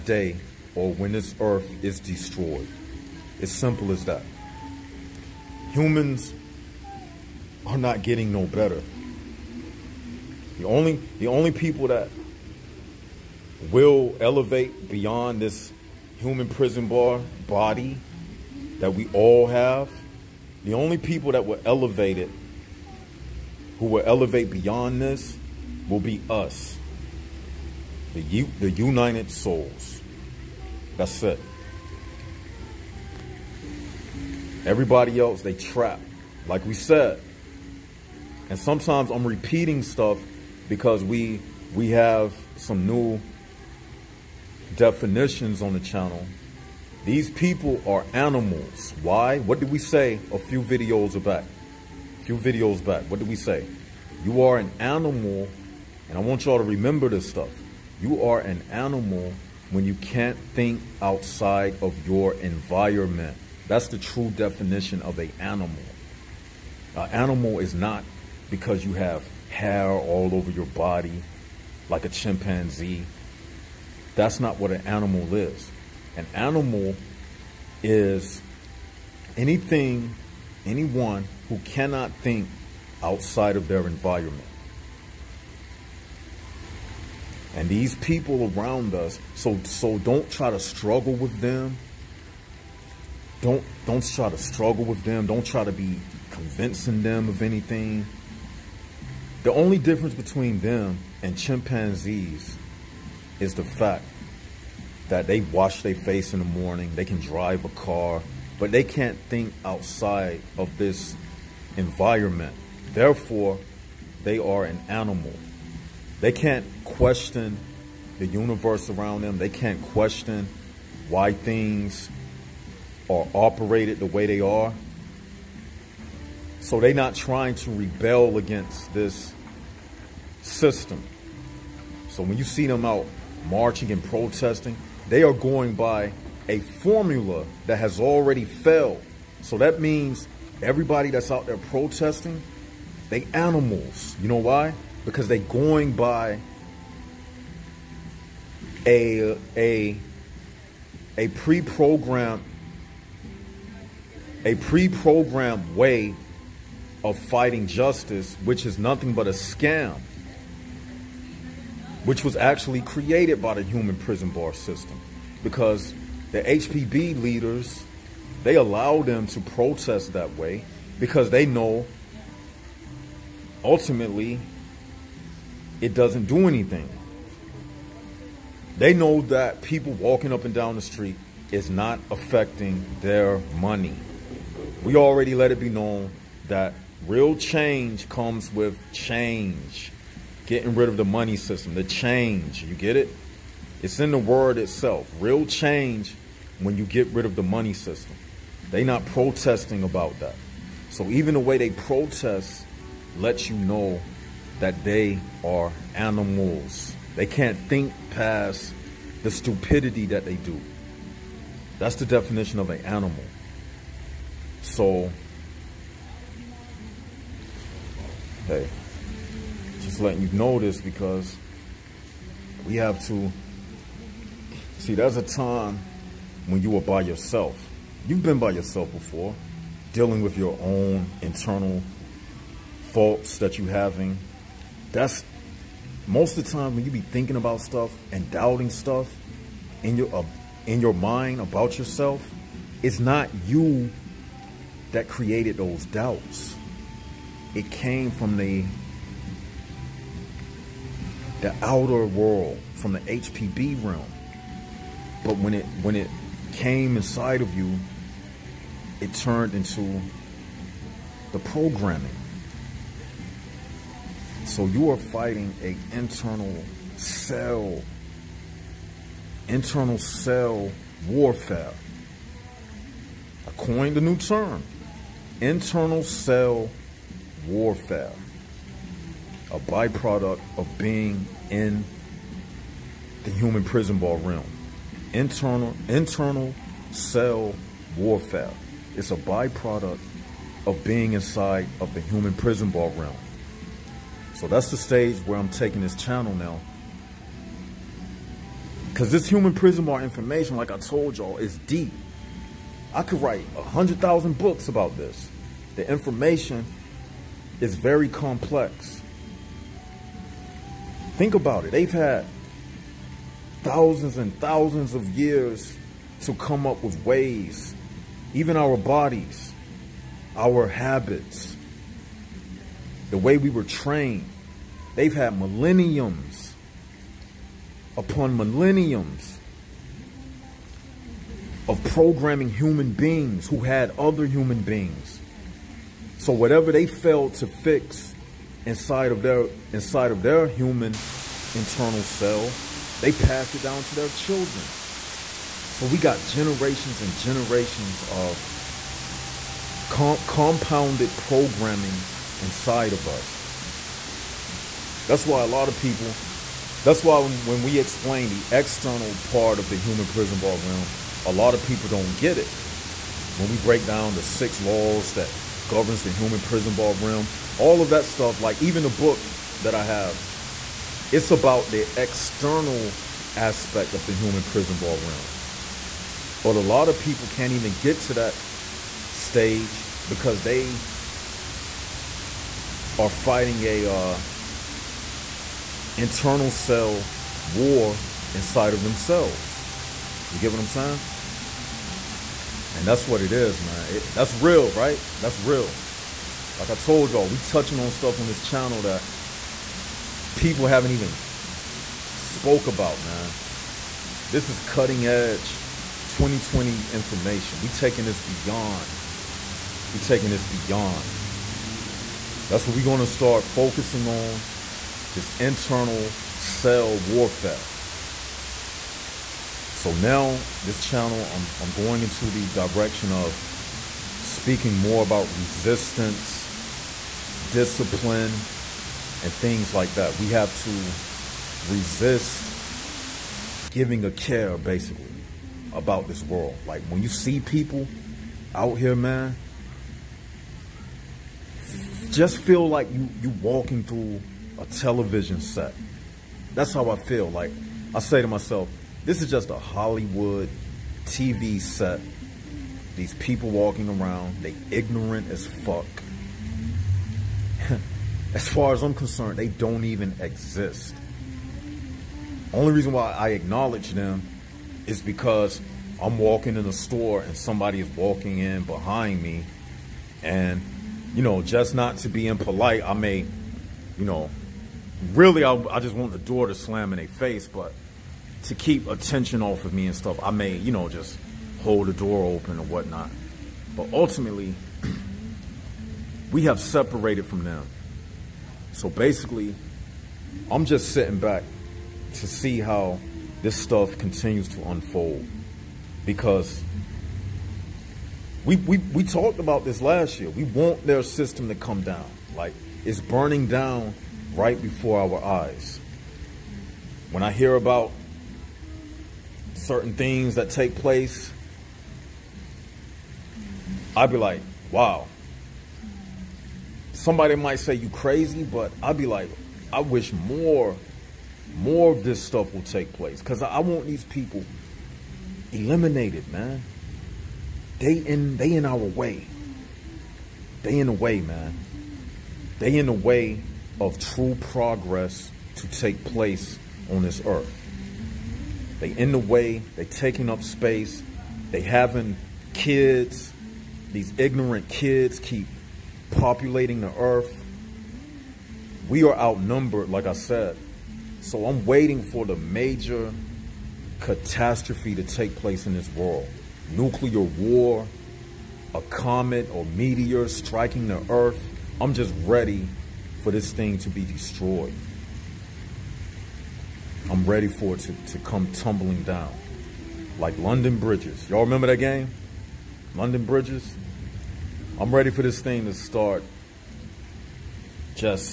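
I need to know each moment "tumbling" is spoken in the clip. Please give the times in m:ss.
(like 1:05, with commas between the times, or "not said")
9:28.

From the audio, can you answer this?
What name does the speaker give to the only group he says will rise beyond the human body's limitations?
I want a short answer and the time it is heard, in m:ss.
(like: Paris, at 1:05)
The United Souls, at 0:28.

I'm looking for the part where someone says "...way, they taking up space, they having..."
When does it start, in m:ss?
8:59.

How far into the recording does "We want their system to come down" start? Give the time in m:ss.
8:20.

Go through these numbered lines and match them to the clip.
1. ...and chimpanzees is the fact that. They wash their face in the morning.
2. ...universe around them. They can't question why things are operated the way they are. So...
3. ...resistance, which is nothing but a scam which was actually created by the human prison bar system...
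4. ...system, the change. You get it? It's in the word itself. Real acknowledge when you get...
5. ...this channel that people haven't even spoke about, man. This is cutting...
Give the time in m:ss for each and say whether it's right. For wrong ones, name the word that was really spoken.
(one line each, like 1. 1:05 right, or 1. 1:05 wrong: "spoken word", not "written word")
1. 1:41 right
2. 1:58 right
3. 2:37 wrong: "justice", not "resistance"
4. 3:11 wrong: "change", not "acknowledge"
5. 6:38 right.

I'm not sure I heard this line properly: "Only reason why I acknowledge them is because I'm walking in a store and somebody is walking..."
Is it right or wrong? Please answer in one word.
right.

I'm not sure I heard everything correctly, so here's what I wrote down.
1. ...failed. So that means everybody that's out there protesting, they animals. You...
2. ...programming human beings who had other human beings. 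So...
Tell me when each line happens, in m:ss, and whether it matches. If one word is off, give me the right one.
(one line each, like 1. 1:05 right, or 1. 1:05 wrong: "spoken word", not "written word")
1. 2:18 right
2. 5:31 right.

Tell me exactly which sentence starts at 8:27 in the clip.
When I hear about certain things that take place I'd be like, wow.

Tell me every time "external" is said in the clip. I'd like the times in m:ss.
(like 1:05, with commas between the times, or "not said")
5:58, 6:12.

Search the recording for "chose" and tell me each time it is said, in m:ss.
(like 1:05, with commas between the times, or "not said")
not said.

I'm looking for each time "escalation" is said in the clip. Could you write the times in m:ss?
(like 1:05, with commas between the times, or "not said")
not said.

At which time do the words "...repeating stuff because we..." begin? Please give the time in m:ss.
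0:39.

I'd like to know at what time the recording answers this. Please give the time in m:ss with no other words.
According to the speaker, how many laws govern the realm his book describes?
6:04.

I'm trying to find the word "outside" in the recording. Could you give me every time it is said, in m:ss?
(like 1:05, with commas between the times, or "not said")
1:01, 1:23, 1:49.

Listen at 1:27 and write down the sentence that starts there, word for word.
And these people around us, so so don't try to struggle with them.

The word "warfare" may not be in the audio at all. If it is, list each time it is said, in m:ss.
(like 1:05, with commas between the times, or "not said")
4:31, 4:37, 4:47, 6:56.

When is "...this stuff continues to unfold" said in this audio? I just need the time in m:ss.
8:13.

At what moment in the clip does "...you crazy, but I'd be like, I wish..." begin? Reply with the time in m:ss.
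8:37.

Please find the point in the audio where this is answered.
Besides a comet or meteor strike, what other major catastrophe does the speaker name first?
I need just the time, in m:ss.
9:16.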